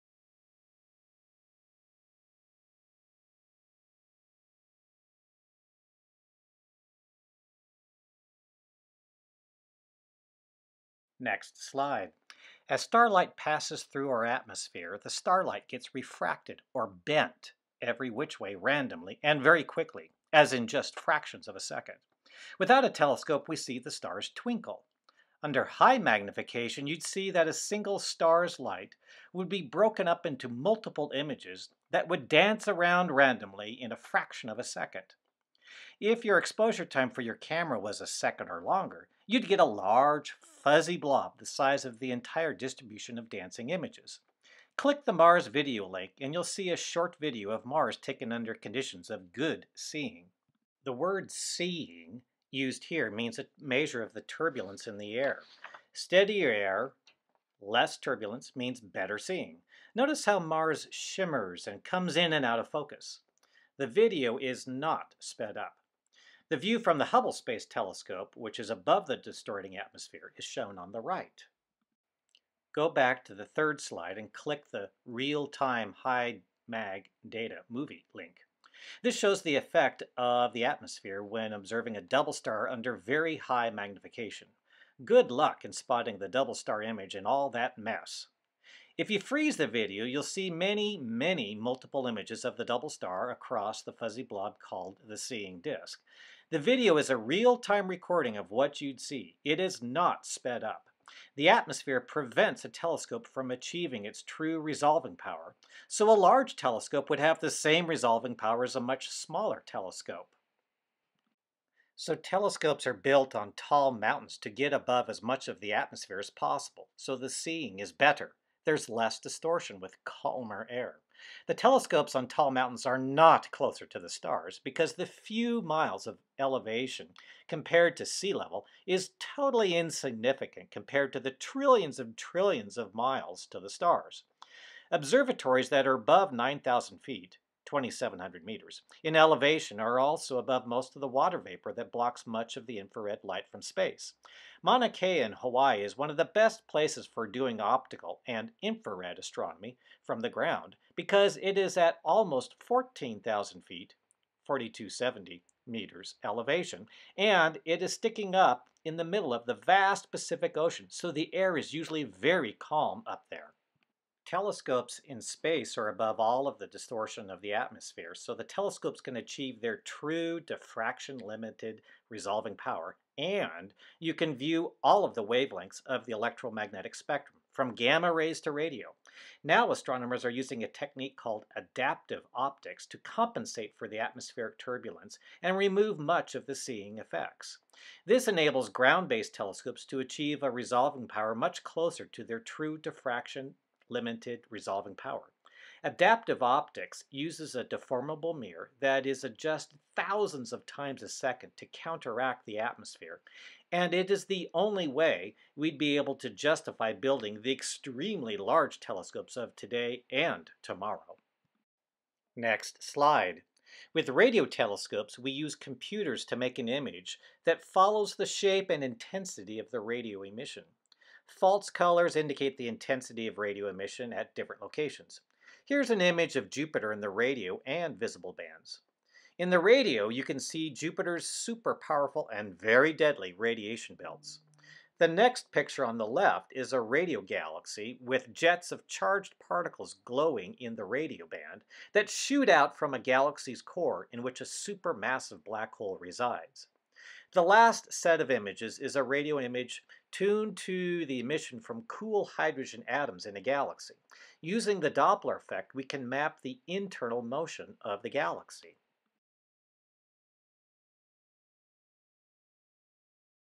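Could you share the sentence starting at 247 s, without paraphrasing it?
The last set of images is a radio image tuned to the emission from cool hydrogen atoms in a galaxy.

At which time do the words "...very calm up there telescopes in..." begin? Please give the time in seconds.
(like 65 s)
162 s.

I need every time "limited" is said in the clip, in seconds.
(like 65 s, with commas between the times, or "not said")
170 s, 193 s.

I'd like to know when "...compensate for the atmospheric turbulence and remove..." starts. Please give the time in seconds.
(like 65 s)
182 s.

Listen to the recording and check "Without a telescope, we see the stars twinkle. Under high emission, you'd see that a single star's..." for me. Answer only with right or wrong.
wrong.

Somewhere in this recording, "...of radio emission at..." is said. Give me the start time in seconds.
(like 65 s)
223 s.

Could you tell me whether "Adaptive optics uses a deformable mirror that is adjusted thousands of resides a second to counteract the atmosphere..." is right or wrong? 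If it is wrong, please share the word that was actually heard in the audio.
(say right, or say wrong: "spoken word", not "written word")
wrong: "times", not "resides".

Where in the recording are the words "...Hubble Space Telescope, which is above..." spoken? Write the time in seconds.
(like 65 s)
67 s.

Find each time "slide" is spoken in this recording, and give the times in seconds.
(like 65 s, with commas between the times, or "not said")
11 s, 73 s, 212 s.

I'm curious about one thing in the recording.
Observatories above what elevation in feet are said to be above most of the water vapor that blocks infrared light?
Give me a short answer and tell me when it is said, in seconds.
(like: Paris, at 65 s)
9,000 feet, at 136 s.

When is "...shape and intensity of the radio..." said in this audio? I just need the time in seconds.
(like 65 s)
218 s.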